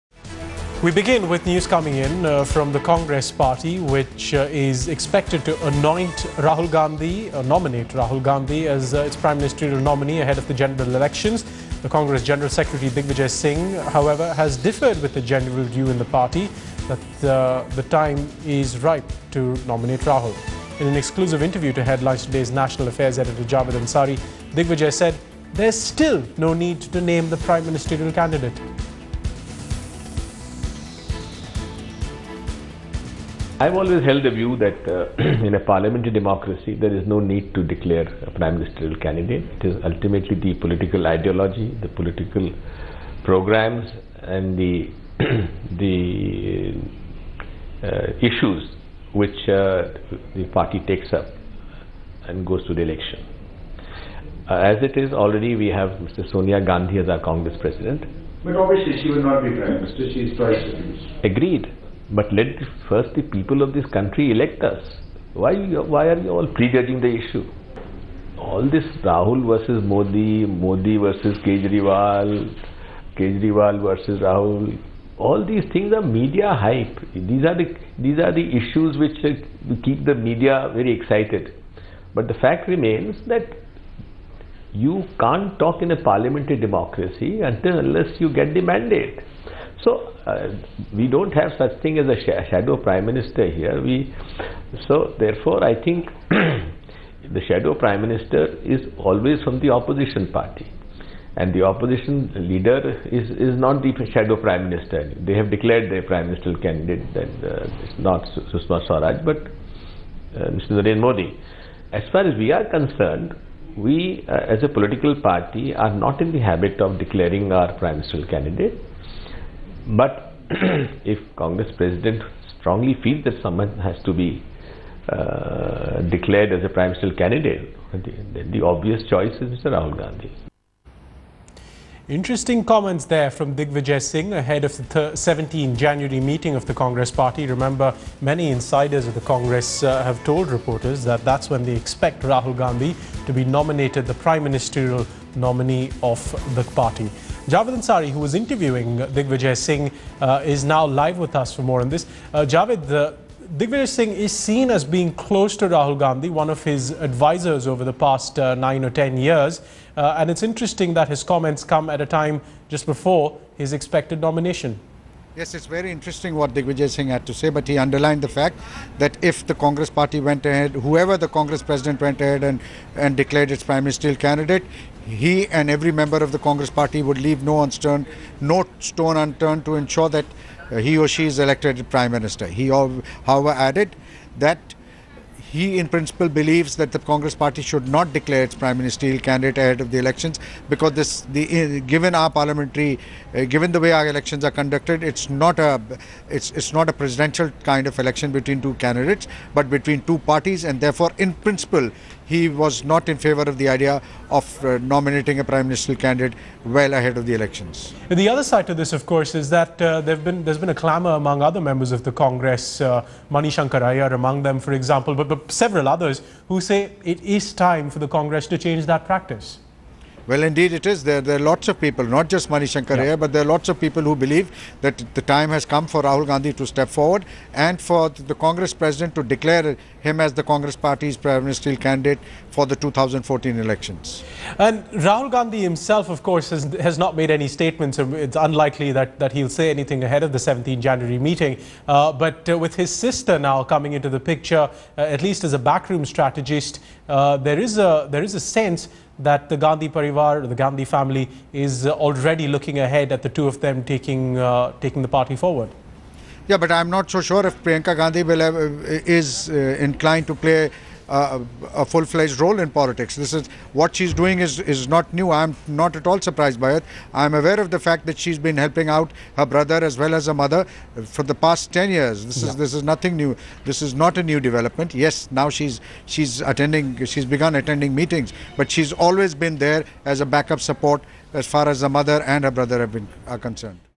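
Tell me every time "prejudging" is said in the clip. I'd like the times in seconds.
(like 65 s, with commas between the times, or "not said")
66 s.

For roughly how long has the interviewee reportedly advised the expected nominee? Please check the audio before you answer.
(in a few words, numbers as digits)
nine or ten years.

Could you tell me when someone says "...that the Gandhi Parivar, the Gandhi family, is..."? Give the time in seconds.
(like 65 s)
249 s.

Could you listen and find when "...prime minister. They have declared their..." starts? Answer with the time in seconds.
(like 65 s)
104 s.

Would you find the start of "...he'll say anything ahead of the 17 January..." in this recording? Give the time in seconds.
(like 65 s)
239 s.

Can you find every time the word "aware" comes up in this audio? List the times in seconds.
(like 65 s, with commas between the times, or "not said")
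267 s.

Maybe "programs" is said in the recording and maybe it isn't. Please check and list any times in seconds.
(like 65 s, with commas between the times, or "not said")
43 s.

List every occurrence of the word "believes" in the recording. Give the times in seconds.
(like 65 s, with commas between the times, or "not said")
186 s, 224 s.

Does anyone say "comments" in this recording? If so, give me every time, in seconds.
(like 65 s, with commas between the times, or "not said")
132 s, 161 s.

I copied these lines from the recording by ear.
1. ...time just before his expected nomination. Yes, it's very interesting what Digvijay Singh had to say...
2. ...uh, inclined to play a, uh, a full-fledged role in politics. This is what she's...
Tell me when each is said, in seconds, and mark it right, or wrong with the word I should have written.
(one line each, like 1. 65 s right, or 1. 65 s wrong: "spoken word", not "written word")
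1. 162 s right
2. 259 s right.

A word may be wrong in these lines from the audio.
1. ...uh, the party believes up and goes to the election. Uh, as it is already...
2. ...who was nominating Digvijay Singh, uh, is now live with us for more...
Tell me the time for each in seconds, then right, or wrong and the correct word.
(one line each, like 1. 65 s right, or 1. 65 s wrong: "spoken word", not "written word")
1. 49 s wrong: "takes", not "believes"
2. 148 s wrong: "interviewing", not "nominating".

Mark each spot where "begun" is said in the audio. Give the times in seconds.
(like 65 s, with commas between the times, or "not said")
277 s.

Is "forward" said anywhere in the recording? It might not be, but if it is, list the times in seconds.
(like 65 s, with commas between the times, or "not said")
226 s, 255 s.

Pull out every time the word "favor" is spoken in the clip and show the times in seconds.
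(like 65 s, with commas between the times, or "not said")
203 s.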